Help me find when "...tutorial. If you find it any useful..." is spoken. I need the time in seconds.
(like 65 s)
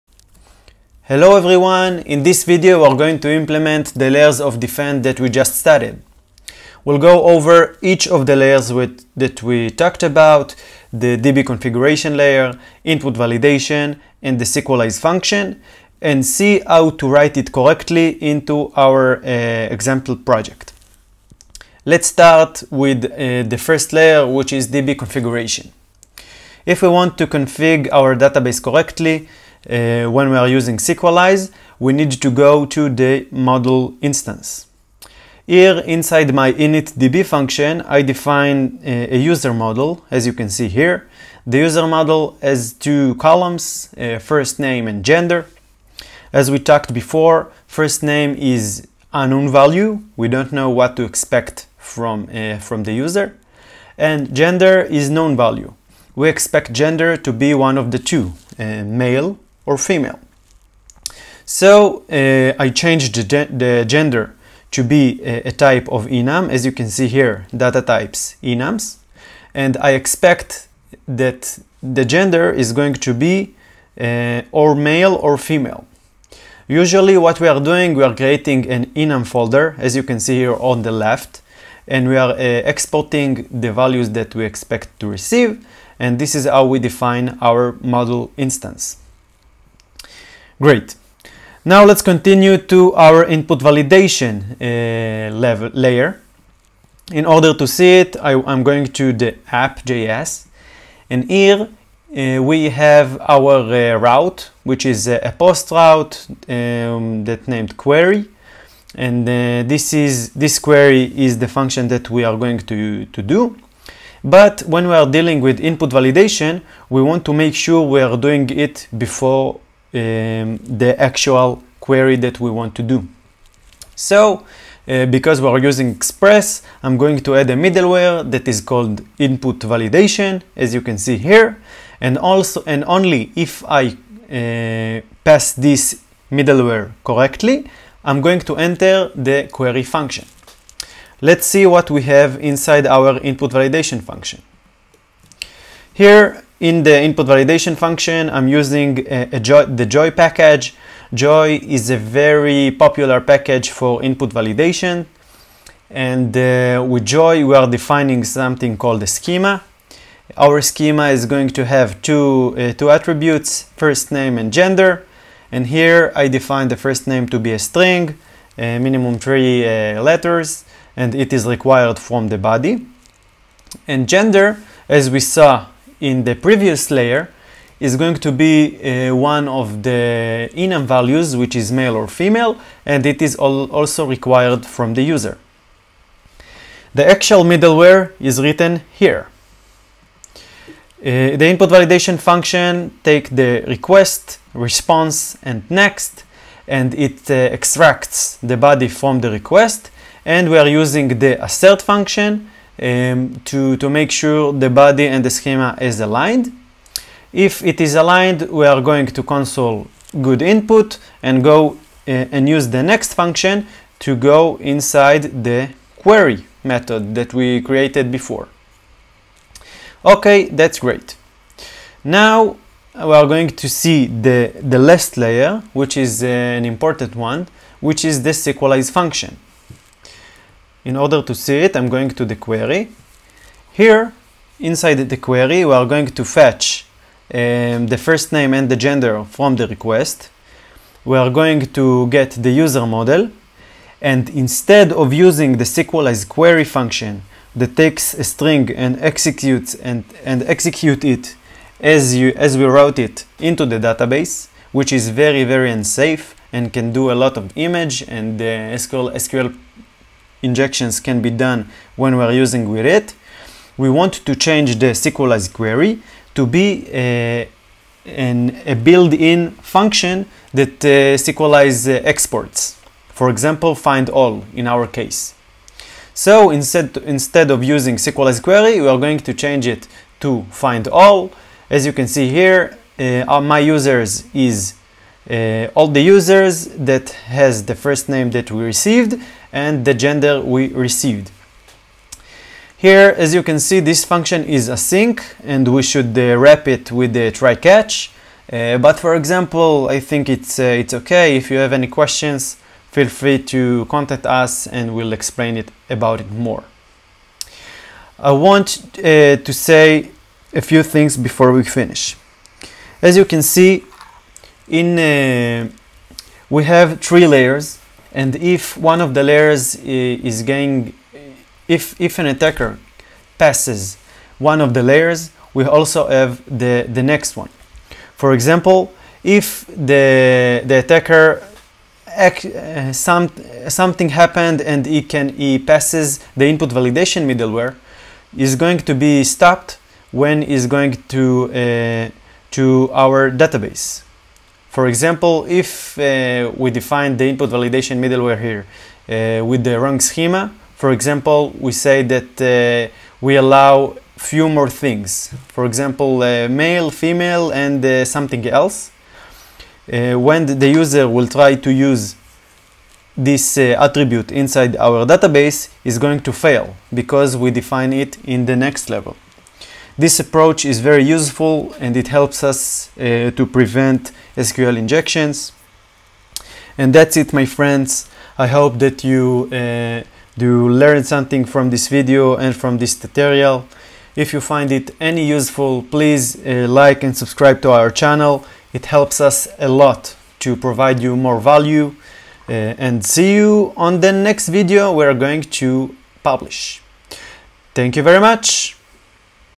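382 s.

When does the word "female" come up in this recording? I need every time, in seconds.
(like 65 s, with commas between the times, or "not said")
59 s, 75 s, 182 s, 356 s.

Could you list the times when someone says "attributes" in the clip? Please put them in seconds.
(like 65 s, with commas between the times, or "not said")
162 s, 363 s.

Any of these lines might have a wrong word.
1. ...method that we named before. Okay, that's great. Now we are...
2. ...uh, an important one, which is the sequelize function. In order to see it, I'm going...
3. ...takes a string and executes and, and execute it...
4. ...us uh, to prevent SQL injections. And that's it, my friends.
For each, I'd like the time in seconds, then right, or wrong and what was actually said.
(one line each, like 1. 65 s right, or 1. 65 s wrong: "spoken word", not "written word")
1. 216 s wrong: "created", not "named"
2. 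226 s right
3. 247 s right
4. 372 s right.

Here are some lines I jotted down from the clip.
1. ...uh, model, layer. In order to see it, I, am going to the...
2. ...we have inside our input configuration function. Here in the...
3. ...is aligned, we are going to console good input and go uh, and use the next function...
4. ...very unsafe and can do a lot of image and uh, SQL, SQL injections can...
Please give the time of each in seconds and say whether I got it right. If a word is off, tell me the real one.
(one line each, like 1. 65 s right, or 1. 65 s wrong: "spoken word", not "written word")
1. 94 s wrong: "level", not "model"
2. 141 s wrong: "validation", not "configuration"
3. 207 s right
4. 255 s right.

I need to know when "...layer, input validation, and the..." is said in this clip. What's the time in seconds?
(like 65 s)
12 s.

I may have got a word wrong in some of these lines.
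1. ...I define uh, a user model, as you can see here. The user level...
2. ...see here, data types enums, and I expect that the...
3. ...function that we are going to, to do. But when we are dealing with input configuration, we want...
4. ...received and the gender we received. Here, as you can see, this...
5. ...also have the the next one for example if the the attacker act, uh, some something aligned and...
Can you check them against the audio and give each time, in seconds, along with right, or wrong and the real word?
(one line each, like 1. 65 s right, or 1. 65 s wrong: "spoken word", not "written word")
1. 37 s wrong: "model", not "level"
2. 66 s right
3. 111 s wrong: "validation", not "configuration"
4. 288 s right
5. 325 s wrong: "happened", not "aligned".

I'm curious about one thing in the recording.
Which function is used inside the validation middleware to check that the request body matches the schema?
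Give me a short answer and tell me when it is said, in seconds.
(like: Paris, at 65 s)
assert, at 201 s.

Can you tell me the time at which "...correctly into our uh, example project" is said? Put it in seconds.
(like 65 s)
17 s.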